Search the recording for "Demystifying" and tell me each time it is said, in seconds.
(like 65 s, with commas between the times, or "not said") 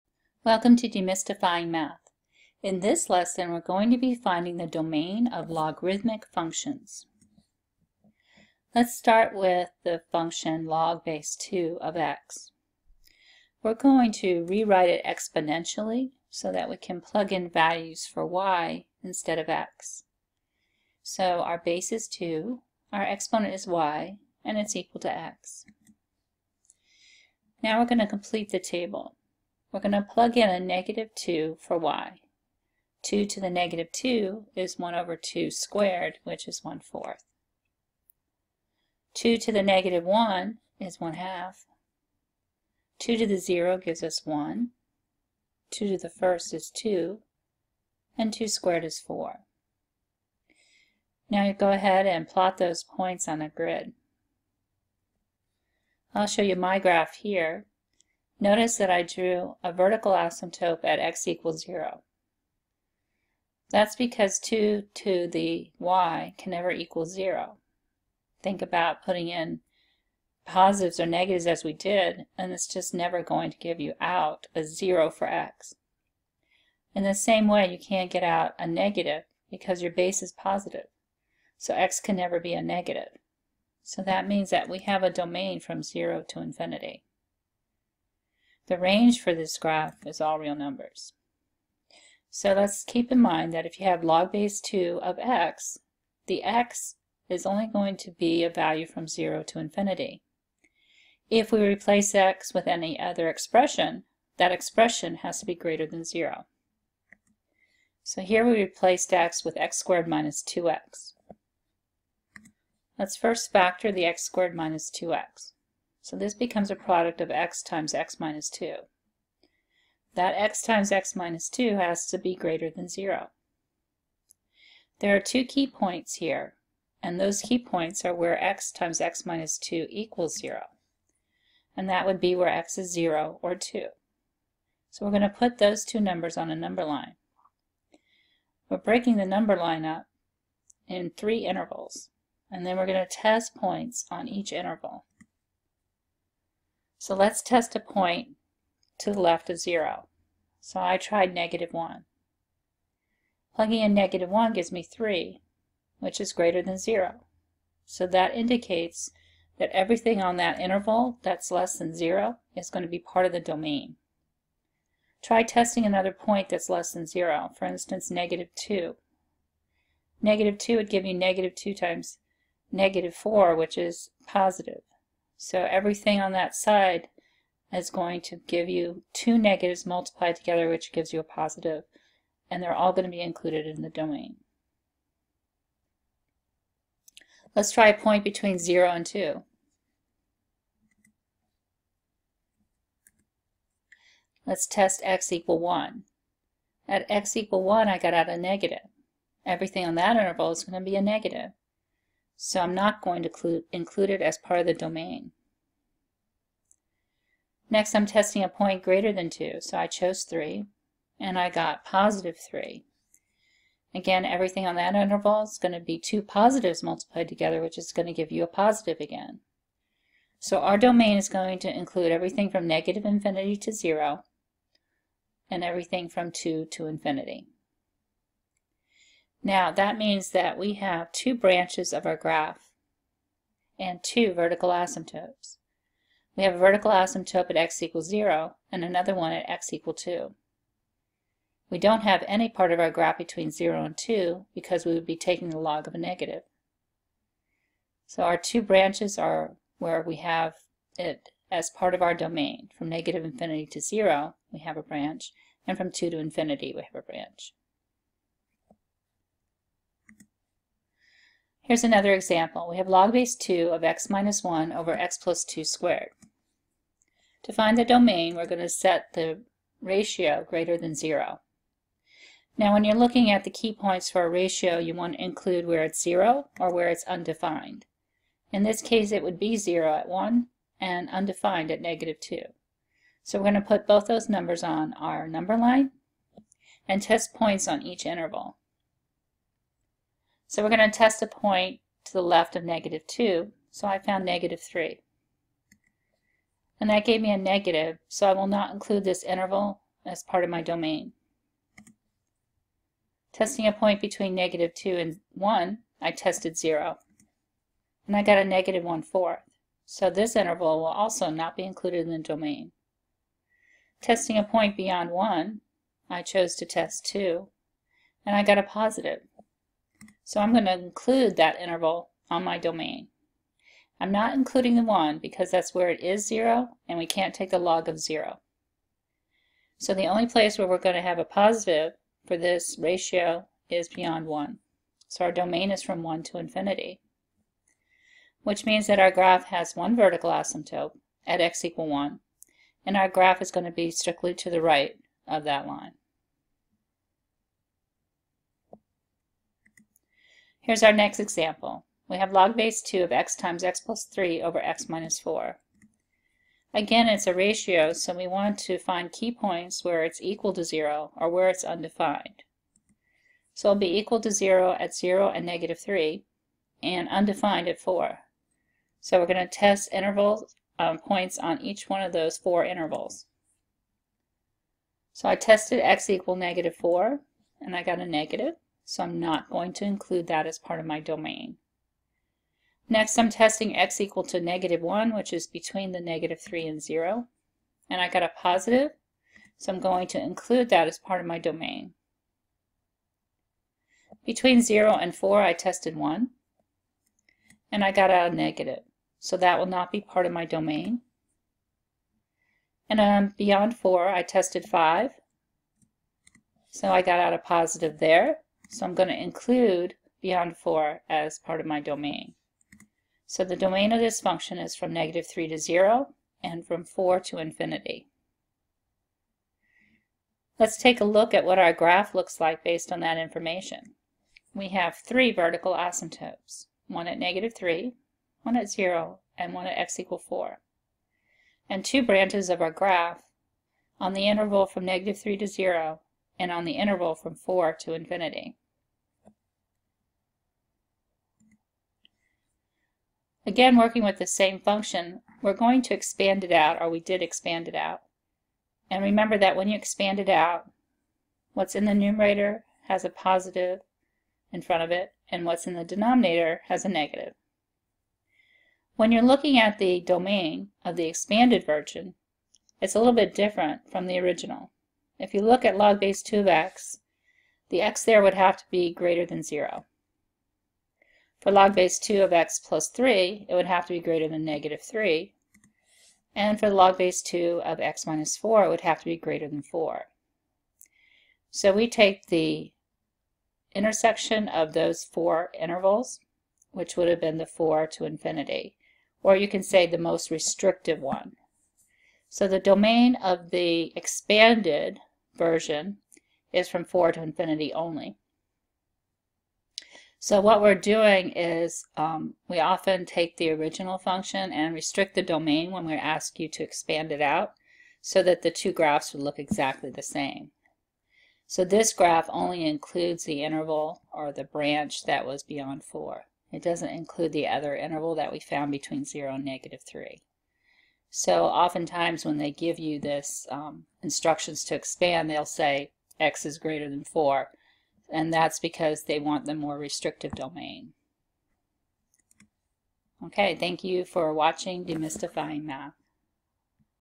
0 s, 534 s.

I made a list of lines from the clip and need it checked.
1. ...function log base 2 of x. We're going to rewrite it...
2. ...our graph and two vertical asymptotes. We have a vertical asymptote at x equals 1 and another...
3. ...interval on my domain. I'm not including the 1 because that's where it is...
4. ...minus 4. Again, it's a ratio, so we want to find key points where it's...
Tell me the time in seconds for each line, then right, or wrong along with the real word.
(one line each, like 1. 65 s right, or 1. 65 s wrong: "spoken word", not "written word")
1. 10 s right
2. 232 s wrong: "0", not "1"
3. 321 s right
4. 354 s right.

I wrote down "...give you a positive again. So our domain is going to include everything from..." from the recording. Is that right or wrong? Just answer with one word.
right.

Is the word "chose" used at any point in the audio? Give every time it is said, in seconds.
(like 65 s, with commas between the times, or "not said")
209 s, 316 s.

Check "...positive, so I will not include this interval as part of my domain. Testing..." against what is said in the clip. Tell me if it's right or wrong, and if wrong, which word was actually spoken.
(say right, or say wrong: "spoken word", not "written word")
wrong: "negative", not "positive".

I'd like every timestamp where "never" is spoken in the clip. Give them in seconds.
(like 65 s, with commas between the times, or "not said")
66 s, 72 s, 82 s.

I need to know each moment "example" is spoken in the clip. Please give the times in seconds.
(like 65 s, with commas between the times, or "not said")
262 s, 351 s.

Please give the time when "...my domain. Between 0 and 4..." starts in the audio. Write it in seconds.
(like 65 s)
391 s.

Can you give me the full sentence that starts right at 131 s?
And that would be where x is 0 or 2.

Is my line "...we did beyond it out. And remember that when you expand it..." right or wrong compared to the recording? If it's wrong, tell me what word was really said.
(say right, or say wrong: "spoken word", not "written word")
wrong: "expand", not "beyond".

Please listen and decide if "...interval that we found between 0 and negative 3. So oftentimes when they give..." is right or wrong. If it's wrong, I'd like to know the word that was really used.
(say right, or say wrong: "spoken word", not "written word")
right.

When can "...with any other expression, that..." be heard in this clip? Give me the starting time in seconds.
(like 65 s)
102 s.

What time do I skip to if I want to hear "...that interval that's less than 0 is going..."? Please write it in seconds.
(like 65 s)
160 s.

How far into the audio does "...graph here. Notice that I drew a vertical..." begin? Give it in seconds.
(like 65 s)
56 s.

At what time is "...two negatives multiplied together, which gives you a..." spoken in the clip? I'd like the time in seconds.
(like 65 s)
179 s.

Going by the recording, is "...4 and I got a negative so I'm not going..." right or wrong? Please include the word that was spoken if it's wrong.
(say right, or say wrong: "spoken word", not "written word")
right.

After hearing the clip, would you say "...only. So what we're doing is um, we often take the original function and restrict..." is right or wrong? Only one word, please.
right.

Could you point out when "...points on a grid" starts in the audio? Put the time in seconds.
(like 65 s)
52 s.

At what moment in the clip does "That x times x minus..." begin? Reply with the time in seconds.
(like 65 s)
120 s.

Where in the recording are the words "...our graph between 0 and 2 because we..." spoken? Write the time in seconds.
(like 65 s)
242 s.